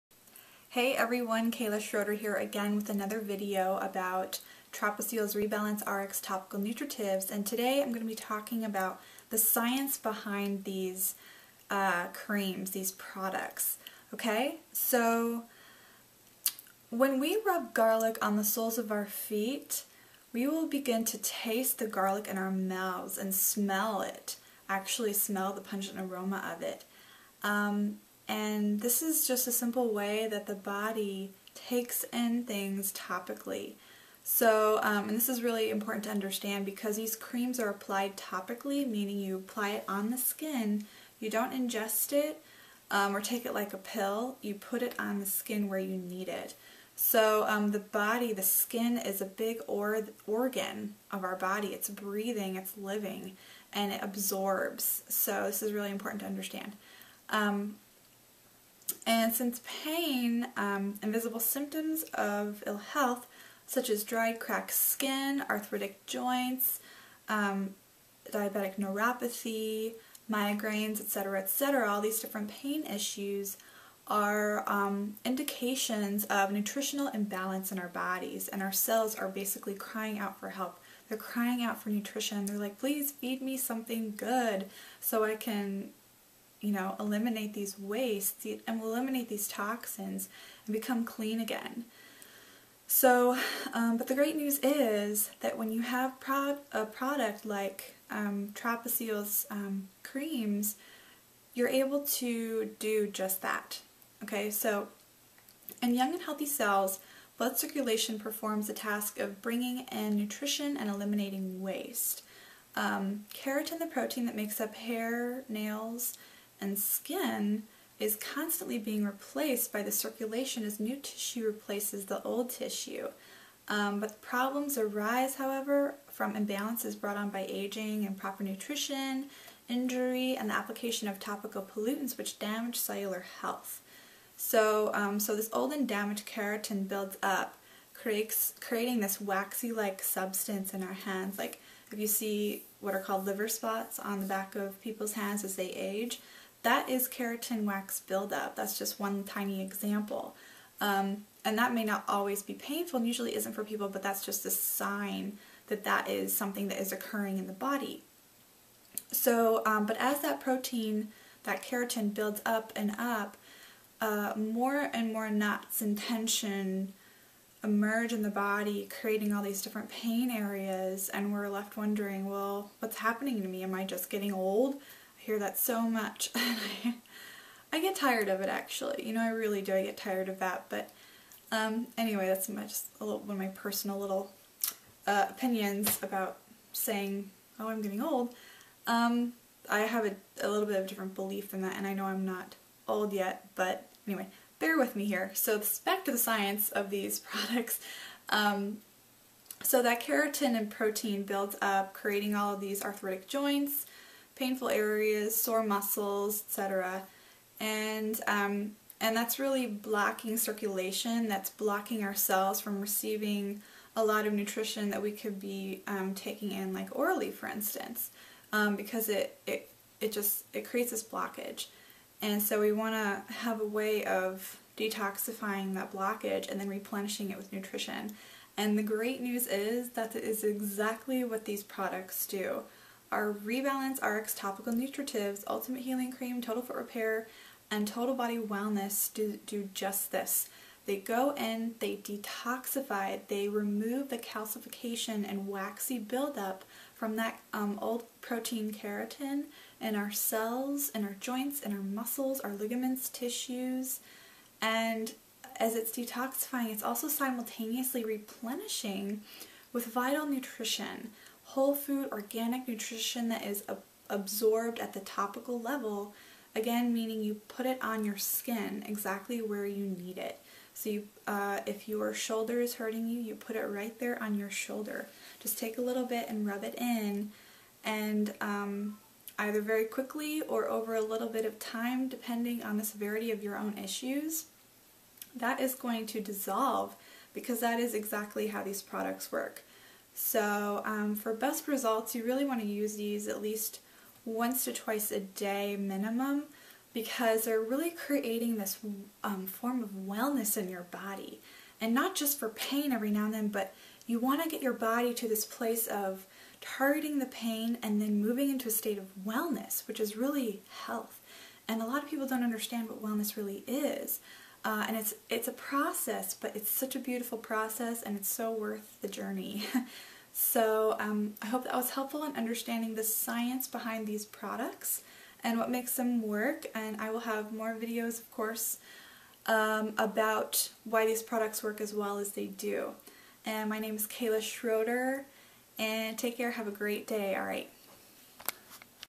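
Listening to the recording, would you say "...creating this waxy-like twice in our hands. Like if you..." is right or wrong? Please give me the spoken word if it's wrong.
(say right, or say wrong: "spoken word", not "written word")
wrong: "substance", not "twice".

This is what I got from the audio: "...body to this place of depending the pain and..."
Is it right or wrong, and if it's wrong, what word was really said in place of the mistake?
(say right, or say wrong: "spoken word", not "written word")
wrong: "targeting", not "depending".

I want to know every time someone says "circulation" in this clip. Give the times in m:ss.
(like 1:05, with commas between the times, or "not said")
1:47, 1:59, 3:30.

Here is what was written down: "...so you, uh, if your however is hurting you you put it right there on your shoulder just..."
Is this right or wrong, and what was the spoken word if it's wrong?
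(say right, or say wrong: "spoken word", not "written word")
wrong: "shoulder", not "however".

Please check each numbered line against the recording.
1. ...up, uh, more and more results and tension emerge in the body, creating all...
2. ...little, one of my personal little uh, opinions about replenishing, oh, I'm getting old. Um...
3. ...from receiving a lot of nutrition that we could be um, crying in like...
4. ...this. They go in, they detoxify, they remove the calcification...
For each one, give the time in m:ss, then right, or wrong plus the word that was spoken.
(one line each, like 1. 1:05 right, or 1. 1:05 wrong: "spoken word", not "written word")
1. 2:42 wrong: "knots", not "results"
2. 3:03 wrong: "saying", not "replenishing"
3. 3:32 wrong: "taking", not "crying"
4. 4:00 right.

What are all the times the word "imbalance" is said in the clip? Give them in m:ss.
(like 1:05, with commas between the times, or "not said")
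1:17, 2:06.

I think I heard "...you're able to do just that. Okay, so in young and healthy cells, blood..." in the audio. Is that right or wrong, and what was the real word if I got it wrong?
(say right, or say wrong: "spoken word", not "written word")
right.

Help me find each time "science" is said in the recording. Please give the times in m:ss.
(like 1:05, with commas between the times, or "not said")
0:09, 3:16, 5:23.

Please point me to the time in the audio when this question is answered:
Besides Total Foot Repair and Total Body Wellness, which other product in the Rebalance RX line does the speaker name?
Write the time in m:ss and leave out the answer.
3:55.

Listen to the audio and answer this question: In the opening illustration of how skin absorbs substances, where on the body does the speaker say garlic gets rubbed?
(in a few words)
soles of our feet.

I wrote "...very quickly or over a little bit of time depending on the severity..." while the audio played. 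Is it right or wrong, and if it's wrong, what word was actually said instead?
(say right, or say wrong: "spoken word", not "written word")
right.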